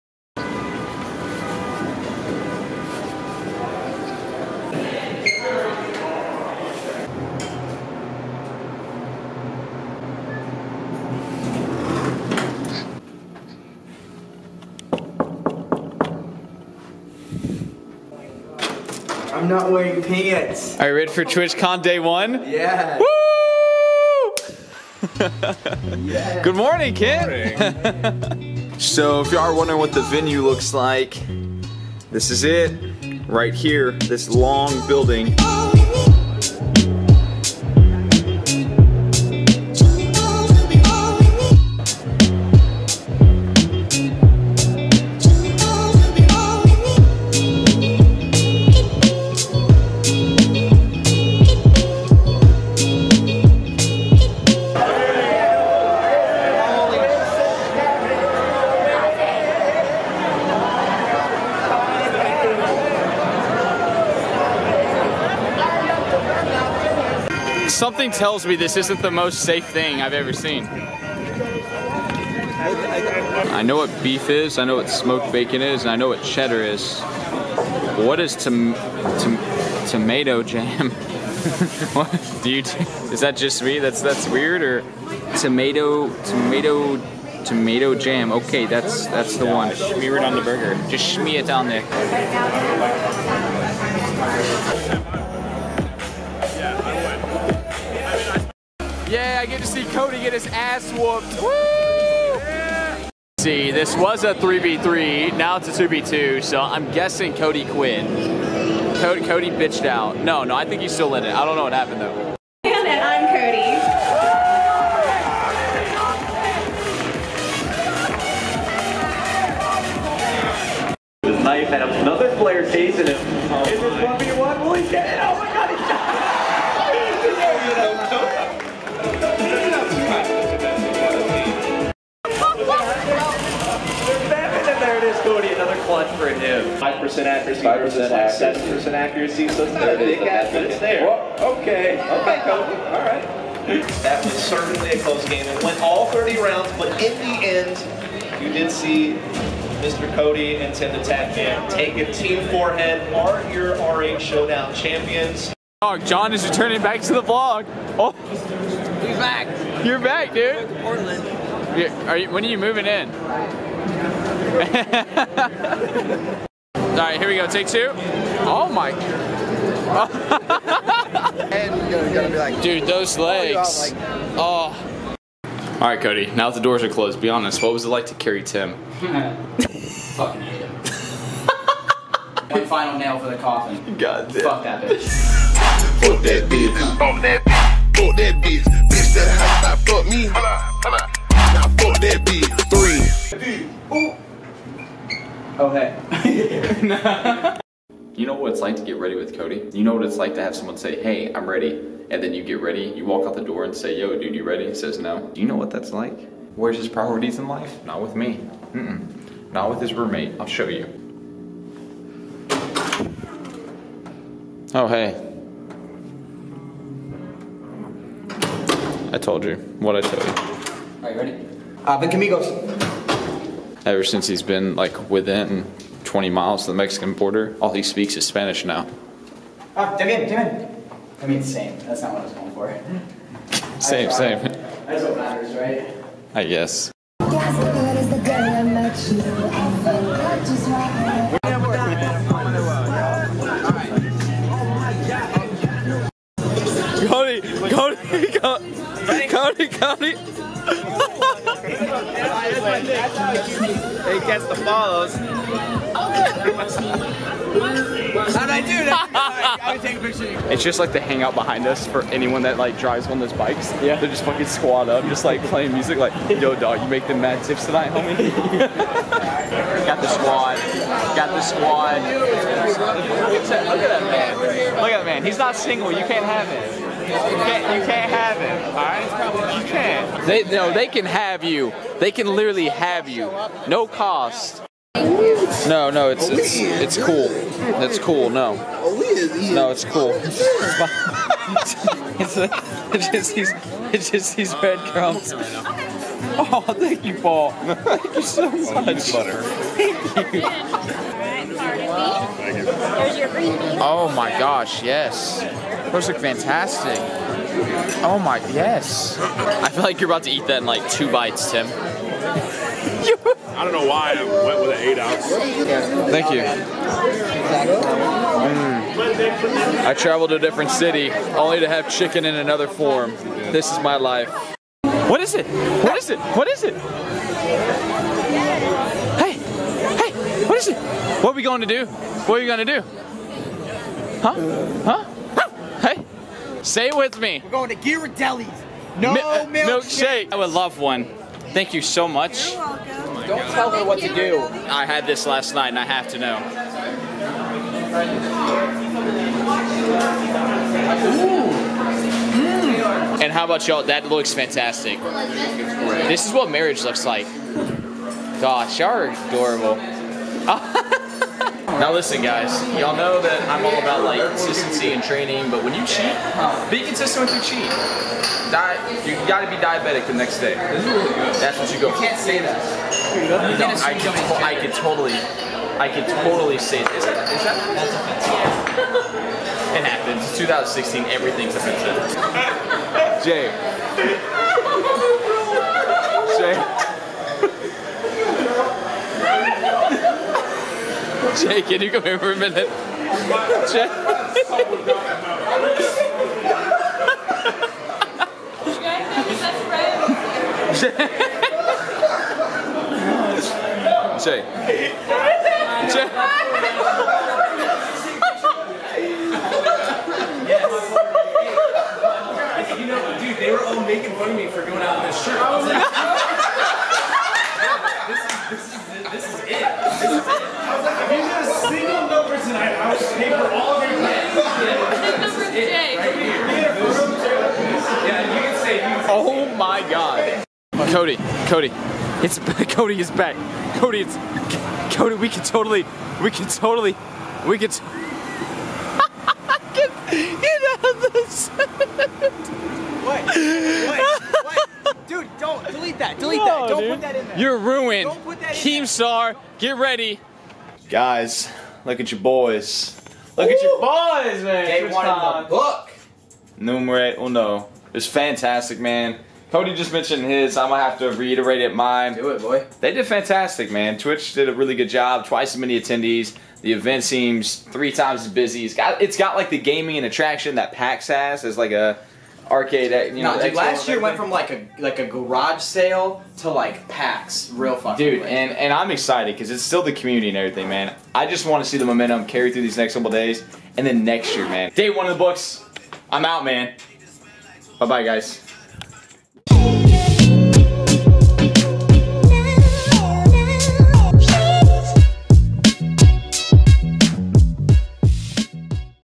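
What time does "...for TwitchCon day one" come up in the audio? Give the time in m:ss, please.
0:21.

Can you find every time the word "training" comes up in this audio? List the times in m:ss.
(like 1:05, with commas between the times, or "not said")
6:05.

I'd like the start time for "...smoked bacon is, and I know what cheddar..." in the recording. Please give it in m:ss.
1:14.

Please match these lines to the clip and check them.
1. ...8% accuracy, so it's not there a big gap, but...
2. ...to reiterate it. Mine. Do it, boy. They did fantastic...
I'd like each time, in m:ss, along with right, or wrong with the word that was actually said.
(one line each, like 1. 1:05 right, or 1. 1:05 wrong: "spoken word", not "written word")
1. 2:18 wrong: "7", not "8"
2. 7:40 right.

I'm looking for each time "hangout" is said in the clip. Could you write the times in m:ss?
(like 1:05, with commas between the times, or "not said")
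4:20.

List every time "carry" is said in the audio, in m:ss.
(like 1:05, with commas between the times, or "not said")
2:58, 8:02.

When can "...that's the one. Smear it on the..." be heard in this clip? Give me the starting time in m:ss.
1:29.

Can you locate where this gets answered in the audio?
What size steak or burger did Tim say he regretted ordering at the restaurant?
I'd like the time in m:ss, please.
5:14.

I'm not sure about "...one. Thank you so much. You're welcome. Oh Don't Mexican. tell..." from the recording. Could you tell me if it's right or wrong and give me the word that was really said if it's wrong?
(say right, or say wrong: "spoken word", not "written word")
wrong: "God", not "Mexican".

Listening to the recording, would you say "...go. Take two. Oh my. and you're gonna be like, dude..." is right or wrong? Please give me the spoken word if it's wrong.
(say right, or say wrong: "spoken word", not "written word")
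right.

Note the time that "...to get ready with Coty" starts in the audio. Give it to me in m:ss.
3:18.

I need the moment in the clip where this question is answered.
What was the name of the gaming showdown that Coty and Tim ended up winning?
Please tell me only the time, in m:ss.
2:33.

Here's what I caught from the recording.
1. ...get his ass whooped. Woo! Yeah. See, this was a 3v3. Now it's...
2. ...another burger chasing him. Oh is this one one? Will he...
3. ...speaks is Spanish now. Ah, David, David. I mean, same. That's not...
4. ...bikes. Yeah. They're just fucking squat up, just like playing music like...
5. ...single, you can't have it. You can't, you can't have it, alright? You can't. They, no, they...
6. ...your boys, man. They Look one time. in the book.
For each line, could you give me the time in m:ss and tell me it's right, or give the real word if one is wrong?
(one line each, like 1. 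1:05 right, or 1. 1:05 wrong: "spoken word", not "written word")
1. 1:40 right
2. 2:01 wrong: "player", not "burger"
3. 3:47 right
4. 4:23 right
5. 4:35 right
6. 7:33 wrong: "First", not "Look".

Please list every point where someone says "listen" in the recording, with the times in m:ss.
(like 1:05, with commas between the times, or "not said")
6:01.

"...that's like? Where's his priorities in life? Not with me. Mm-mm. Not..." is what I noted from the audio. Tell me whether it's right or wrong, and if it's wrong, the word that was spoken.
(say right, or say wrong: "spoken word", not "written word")
right.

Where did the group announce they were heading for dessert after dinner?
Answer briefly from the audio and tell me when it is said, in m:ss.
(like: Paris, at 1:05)
Ghirardelli's, at 5:37.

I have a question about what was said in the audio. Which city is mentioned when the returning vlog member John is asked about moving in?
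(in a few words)
Portland.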